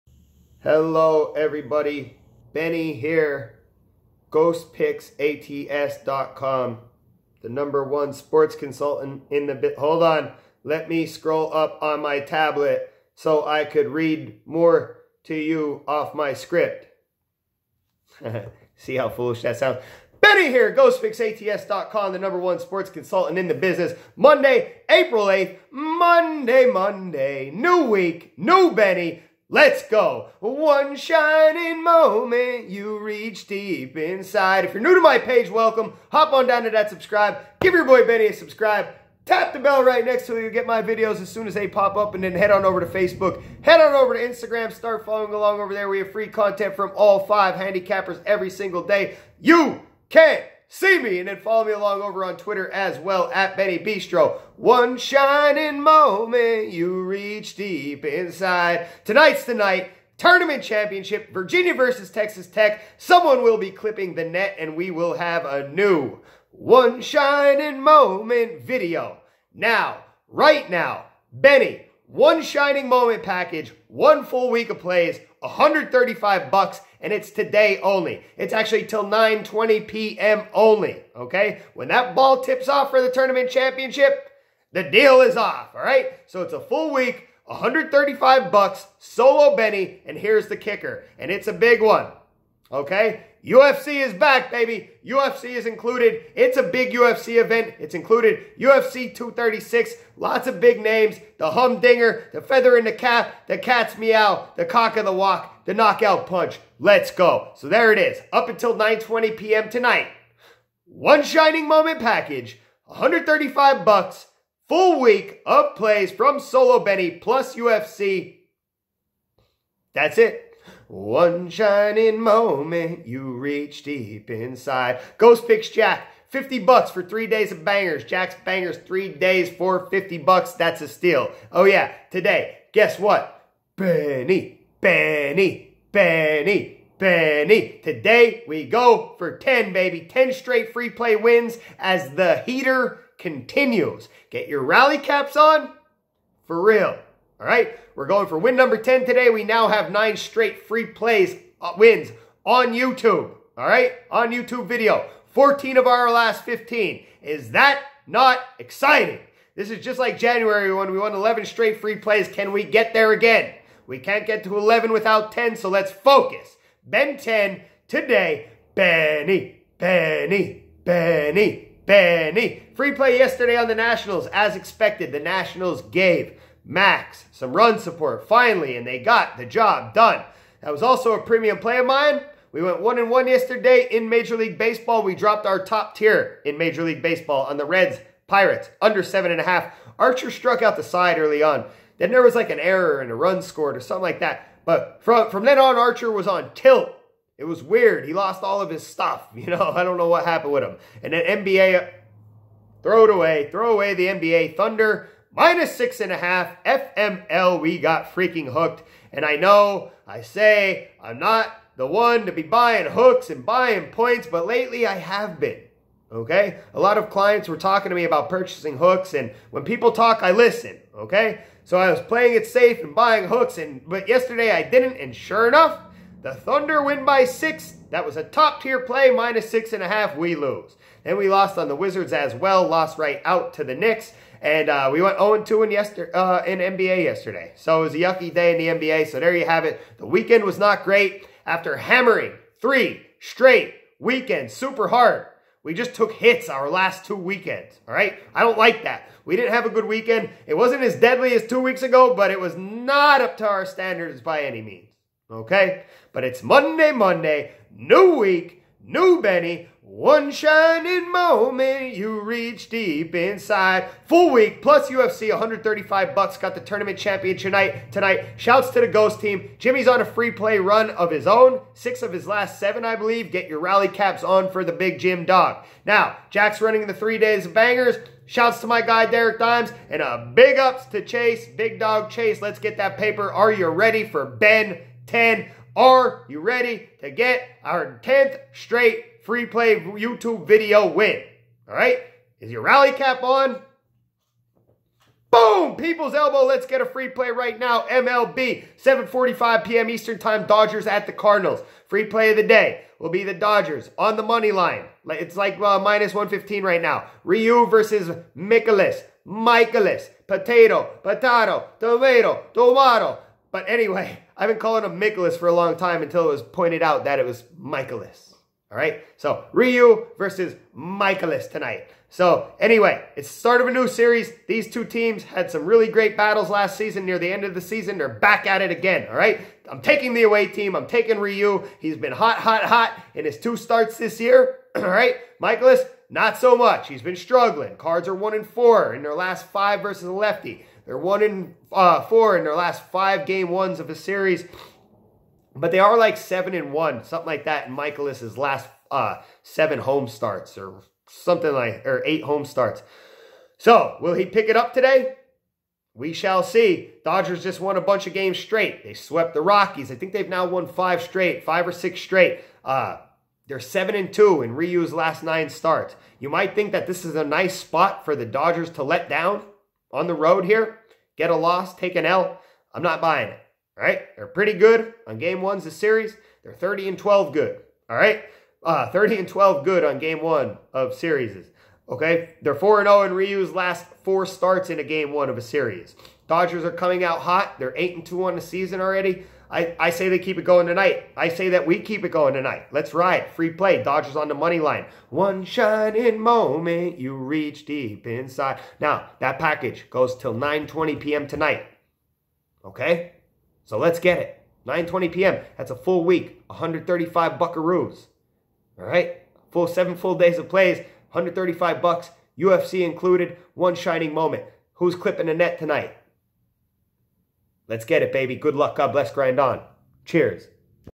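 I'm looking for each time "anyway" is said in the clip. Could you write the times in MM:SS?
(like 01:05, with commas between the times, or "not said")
05:13, 05:22.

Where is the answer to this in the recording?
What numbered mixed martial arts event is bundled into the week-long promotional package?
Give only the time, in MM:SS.
01:38.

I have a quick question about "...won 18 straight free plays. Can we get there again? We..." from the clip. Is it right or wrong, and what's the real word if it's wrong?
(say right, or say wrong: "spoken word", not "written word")
wrong: "11", not "18".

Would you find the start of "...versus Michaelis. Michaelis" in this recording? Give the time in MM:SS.
05:07.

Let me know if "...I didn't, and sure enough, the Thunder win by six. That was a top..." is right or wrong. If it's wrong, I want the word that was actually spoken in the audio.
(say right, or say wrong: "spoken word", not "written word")
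right.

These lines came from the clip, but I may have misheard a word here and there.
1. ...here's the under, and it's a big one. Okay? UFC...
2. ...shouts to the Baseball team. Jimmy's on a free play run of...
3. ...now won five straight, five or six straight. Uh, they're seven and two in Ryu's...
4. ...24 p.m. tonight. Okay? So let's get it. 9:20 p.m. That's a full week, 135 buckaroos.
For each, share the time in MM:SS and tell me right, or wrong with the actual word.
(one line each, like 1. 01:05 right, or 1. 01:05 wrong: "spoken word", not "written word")
1. 01:30 wrong: "kicker", not "under"
2. 04:28 wrong: "Ghost", not "Baseball"
3. 06:00 right
4. 06:40 wrong: "20", not "24".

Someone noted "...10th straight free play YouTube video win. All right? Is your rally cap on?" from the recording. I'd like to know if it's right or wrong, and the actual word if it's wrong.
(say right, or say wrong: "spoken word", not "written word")
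right.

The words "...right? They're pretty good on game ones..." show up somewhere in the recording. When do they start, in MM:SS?
06:13.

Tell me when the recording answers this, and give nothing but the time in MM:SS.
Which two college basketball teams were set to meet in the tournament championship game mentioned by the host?
01:01.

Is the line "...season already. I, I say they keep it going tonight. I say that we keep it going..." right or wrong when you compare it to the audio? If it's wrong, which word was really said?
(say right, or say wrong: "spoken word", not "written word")
right.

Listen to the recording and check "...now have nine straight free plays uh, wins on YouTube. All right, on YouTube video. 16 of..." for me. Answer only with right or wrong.
wrong.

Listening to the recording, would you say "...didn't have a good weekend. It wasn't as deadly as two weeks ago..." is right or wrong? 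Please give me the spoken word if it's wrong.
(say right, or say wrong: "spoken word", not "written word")
right.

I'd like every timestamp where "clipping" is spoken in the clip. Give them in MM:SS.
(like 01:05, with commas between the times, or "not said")
01:03, 06:54.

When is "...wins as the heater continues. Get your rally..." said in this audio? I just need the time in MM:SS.
02:21.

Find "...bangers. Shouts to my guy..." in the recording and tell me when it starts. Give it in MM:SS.
04:37.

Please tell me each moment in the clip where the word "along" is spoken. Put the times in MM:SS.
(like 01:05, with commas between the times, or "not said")
00:45, 00:51.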